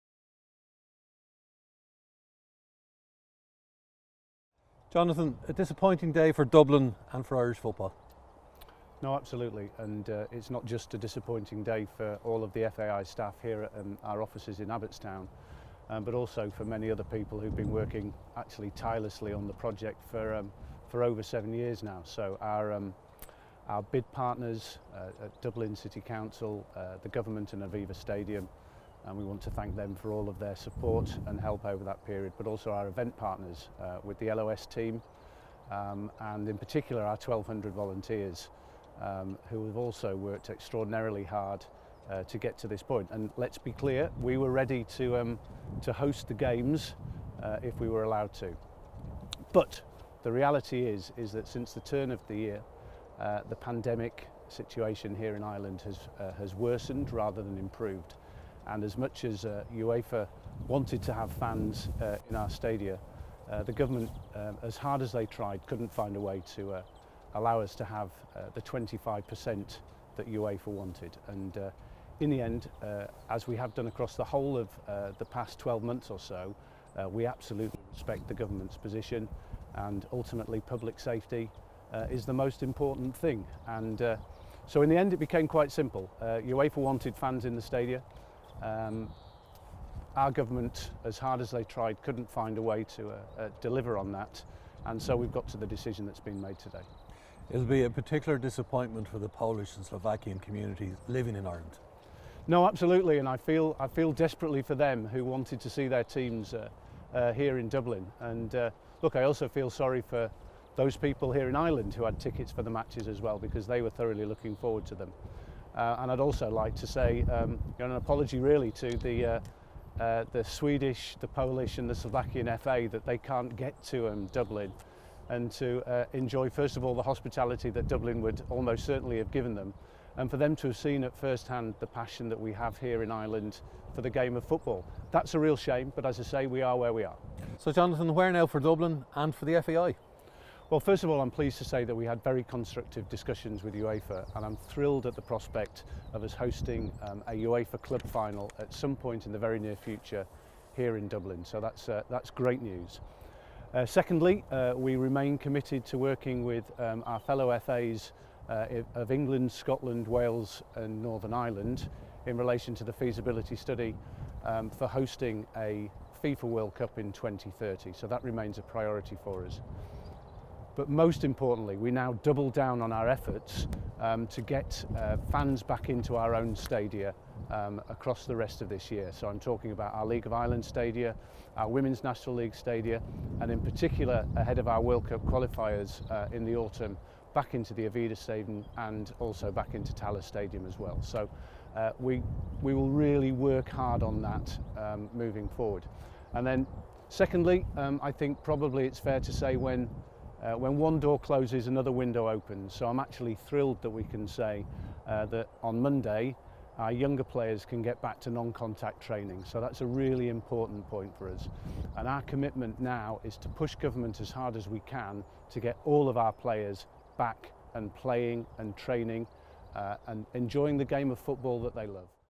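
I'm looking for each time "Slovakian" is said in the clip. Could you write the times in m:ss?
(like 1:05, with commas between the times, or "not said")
1:39, 2:01.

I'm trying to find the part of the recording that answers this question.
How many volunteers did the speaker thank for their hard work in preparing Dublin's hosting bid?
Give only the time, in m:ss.
0:37.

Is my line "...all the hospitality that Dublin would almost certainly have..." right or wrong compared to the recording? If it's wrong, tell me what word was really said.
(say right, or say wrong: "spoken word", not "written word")
right.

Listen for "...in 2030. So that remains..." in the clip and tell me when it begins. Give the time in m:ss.
2:46.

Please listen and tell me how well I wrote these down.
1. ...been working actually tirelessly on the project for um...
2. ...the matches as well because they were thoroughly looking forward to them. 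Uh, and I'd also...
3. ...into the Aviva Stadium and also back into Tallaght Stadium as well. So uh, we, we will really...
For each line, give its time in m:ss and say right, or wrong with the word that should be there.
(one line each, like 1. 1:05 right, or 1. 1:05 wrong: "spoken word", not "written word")
1. 0:17 right
2. 1:52 right
3. 3:07 right.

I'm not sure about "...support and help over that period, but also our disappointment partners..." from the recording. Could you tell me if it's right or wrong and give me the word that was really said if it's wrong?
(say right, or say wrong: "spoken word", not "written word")
wrong: "event", not "disappointment".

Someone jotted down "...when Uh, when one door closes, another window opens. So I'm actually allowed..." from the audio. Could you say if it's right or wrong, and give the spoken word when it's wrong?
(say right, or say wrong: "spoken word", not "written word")
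wrong: "thrilled", not "allowed".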